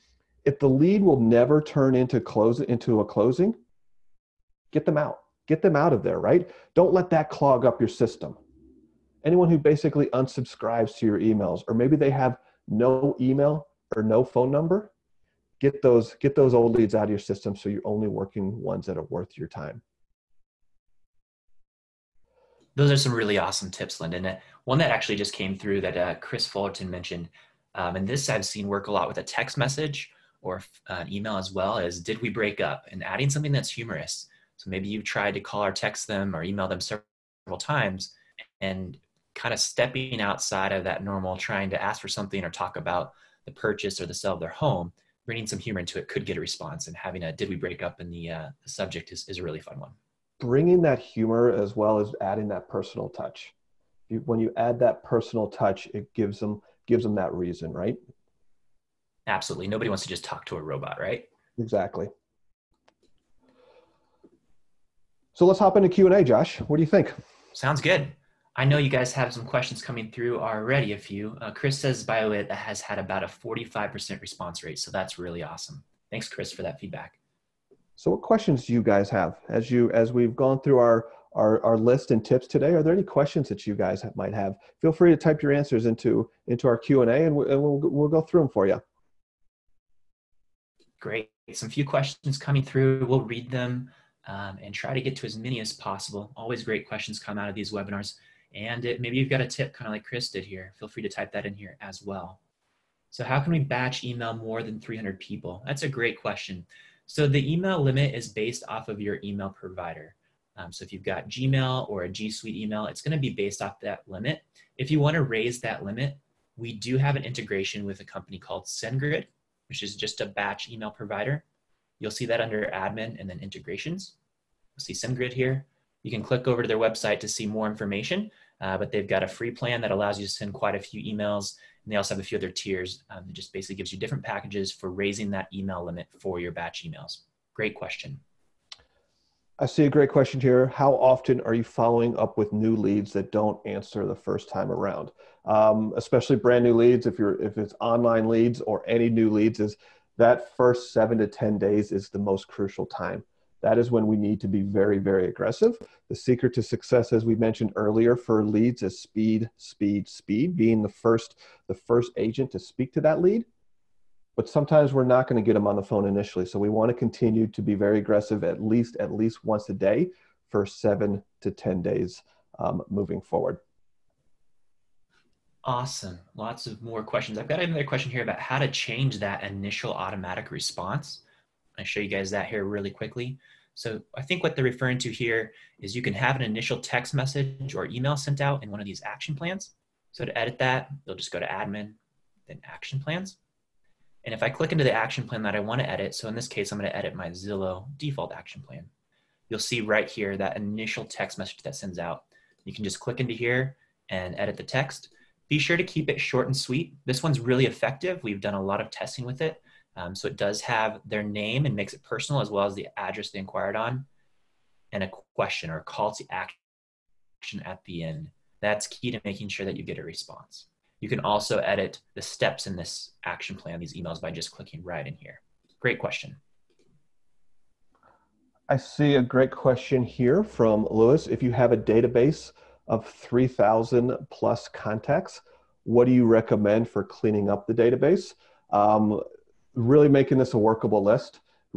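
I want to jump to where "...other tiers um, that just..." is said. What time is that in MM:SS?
02:12.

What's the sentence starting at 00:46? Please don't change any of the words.
And having a did we break up in the, uh, the subject is, is a really fun one.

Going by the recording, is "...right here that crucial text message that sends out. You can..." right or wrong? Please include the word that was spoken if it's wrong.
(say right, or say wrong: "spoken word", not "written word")
wrong: "initial", not "crucial".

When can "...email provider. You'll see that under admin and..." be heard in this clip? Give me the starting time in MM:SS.
02:00.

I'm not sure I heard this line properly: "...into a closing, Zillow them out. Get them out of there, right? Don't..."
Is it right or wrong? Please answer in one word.
wrong.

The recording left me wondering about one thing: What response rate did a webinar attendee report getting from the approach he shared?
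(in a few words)
45%.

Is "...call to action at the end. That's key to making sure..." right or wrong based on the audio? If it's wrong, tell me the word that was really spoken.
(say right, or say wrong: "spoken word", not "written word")
right.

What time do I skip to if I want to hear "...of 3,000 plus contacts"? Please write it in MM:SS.
03:52.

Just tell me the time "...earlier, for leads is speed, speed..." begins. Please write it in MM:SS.
02:37.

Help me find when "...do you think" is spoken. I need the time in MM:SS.
01:06.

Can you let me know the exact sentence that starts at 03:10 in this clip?
So to edit that, you'll just go to admin, then action plans.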